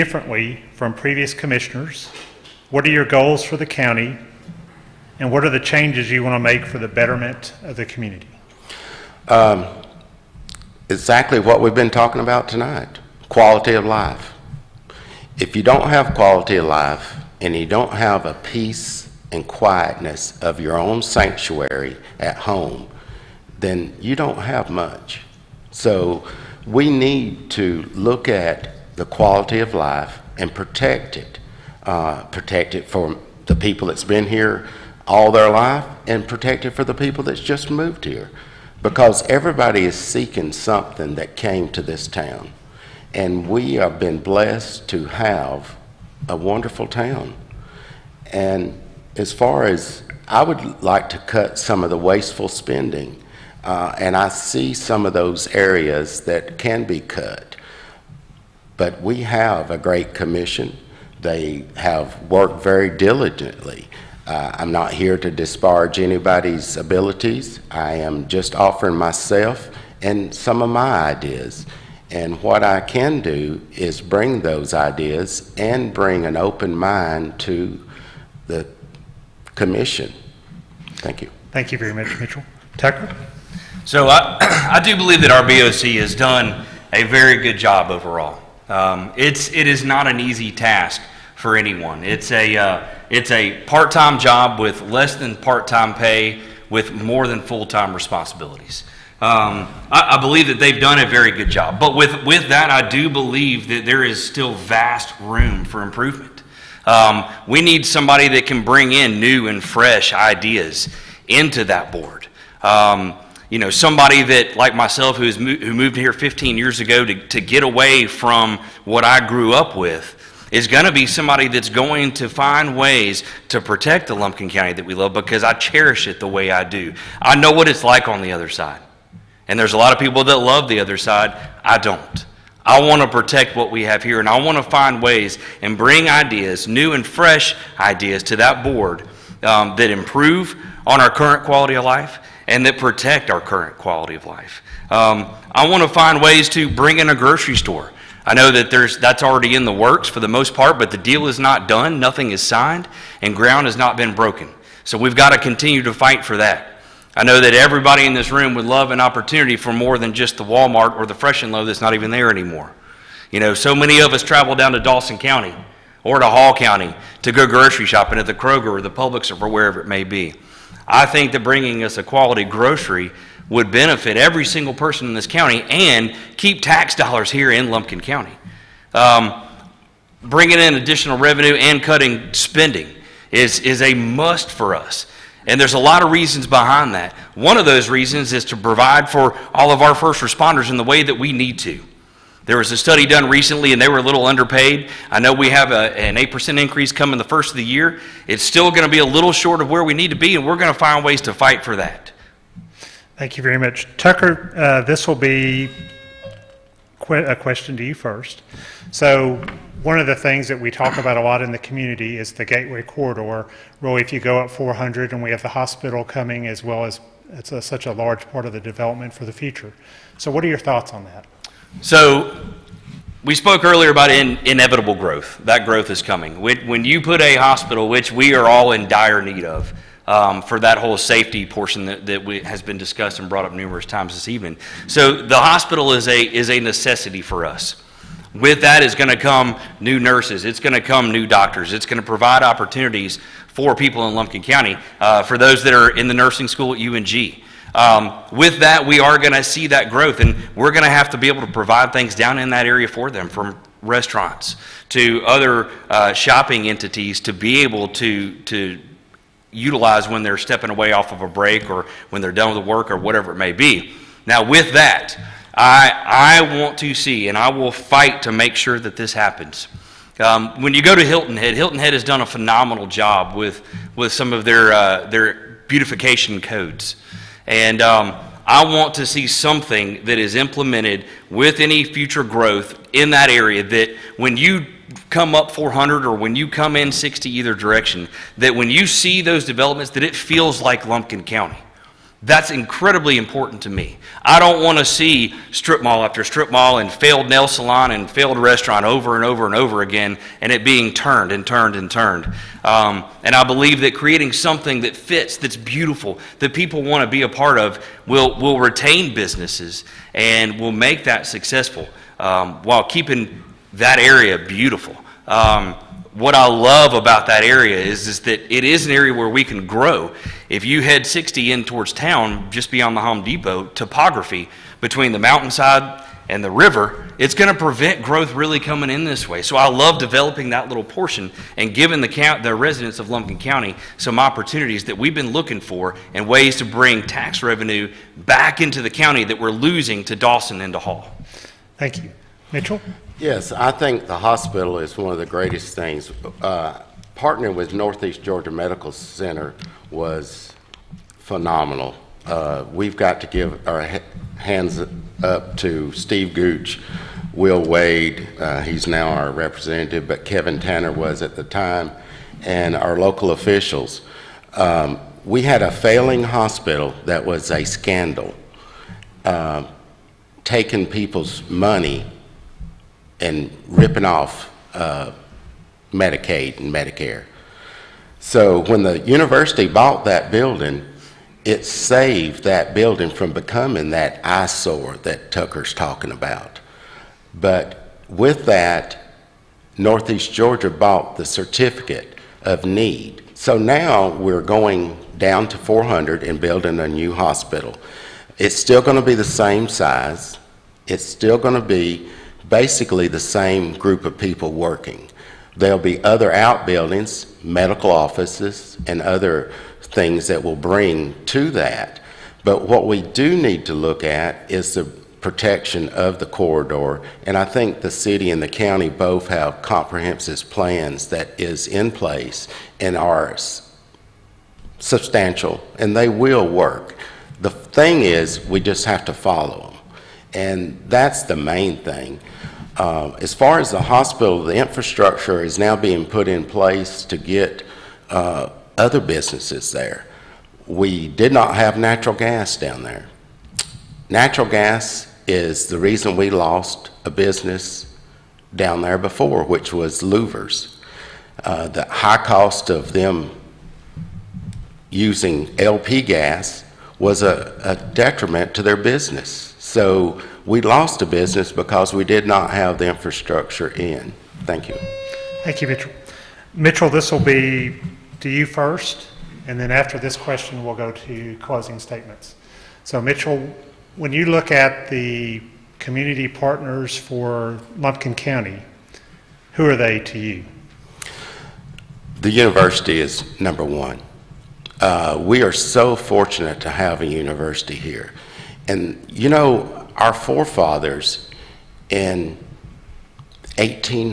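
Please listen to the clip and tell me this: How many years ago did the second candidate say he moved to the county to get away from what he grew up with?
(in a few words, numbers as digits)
15.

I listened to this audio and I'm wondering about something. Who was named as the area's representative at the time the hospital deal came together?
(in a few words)
Kevin Tanner.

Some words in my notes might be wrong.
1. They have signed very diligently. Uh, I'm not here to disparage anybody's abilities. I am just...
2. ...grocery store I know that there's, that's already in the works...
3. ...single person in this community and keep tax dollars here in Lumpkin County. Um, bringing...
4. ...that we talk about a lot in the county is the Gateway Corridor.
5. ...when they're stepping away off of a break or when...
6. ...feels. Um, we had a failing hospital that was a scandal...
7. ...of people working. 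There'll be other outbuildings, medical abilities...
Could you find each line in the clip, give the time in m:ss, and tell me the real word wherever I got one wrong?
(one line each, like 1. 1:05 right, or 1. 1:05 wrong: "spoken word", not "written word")
1. 1:01 wrong: "worked", not "signed"
2. 2:27 right
3. 2:54 wrong: "county", not "community"
4. 3:30 wrong: "community", not "county"
5. 4:20 right
6. 6:03 wrong: "officials", not "feels"
7. 6:44 wrong: "offices", not "abilities".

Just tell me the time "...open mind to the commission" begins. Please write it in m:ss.
1:16.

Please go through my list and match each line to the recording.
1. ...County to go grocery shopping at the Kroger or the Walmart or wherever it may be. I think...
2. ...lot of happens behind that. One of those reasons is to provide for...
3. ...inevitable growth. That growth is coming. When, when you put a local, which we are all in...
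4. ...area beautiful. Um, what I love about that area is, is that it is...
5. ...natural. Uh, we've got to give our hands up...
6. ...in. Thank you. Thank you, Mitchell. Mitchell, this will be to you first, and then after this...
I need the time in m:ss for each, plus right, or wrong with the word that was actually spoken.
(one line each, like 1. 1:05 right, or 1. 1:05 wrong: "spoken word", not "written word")
1. 2:46 wrong: "Publix", not "Walmart"
2. 3:05 wrong: "reasons", not "happens"
3. 3:44 wrong: "hospital", not "local"
4. 5:13 right
5. 5:51 wrong: "phenomenal", not "natural"
6. 7:43 right.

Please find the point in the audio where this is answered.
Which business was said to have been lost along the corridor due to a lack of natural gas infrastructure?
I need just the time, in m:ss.
7:30.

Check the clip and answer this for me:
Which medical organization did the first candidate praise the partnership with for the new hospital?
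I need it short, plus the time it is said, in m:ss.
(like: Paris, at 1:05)
Northeast Georgia Medical Center, at 5:47.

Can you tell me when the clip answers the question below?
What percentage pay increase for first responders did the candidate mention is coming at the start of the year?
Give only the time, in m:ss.
3:16.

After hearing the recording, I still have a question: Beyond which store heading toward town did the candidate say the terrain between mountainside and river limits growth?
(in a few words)
Home Depot.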